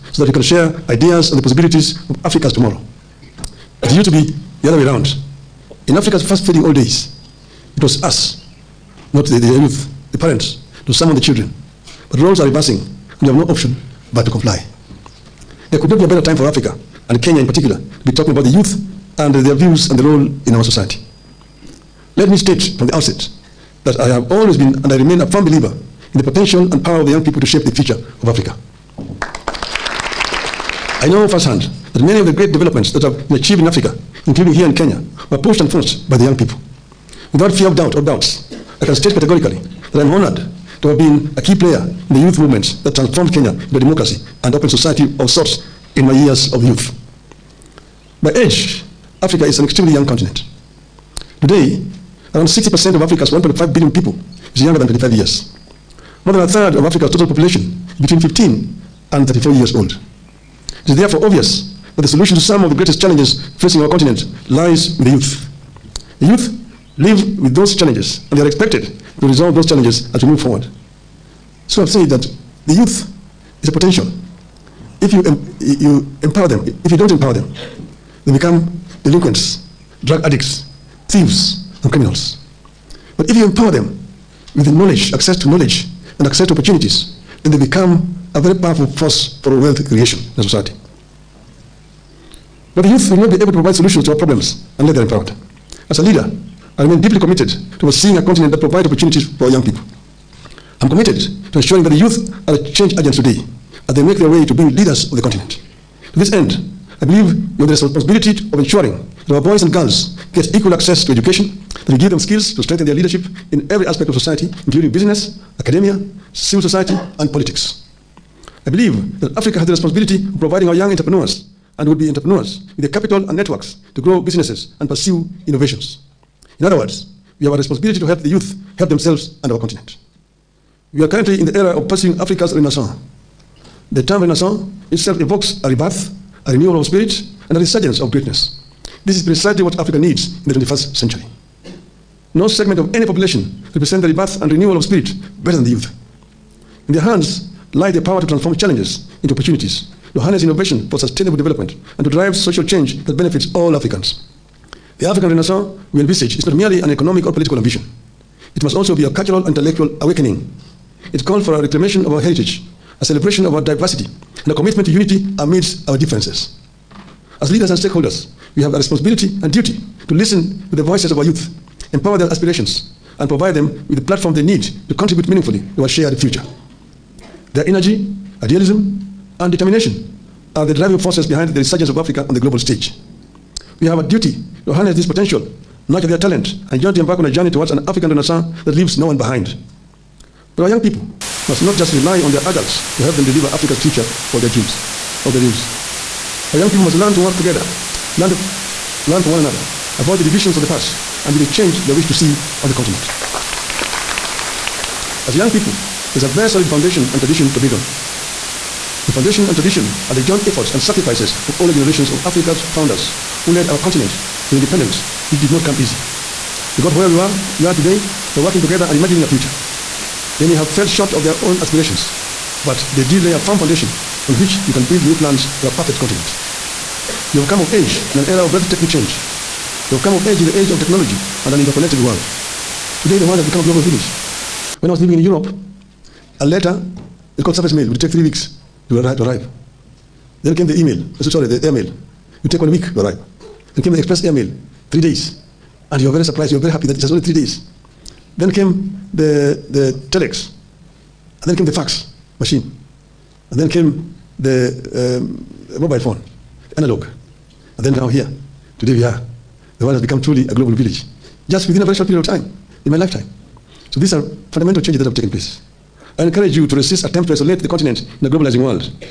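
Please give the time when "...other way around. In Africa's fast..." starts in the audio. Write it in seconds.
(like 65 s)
4 s.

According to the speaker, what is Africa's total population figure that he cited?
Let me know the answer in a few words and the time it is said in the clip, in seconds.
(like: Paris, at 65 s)
1.5 billion, at 53 s.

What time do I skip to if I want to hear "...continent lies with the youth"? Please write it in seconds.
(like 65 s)
63 s.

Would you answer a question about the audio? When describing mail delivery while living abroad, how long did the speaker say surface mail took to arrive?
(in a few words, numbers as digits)
Three weeks.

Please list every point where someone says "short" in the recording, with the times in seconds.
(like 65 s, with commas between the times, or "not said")
220 s, 261 s.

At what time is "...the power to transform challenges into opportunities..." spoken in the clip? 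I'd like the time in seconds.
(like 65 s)
147 s.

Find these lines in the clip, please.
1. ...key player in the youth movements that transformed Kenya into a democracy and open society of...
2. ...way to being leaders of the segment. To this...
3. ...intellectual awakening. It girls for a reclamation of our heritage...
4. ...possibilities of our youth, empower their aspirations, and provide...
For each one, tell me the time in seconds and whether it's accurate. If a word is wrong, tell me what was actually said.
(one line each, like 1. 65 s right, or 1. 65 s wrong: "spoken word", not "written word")
1. 41 s right
2. 104 s wrong: "continent", not "segment"
3. 159 s wrong: "calls", not "girls"
4. 170 s wrong: "voices", not "possibilities".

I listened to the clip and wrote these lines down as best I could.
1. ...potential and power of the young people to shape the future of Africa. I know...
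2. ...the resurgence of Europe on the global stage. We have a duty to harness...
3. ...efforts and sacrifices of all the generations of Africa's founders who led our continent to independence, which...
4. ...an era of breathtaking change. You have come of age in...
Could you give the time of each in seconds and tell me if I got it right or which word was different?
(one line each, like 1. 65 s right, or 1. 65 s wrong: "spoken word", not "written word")
1. 26 s right
2. 181 s wrong: "Africa", not "Europe"
3. 210 s right
4. 228 s right.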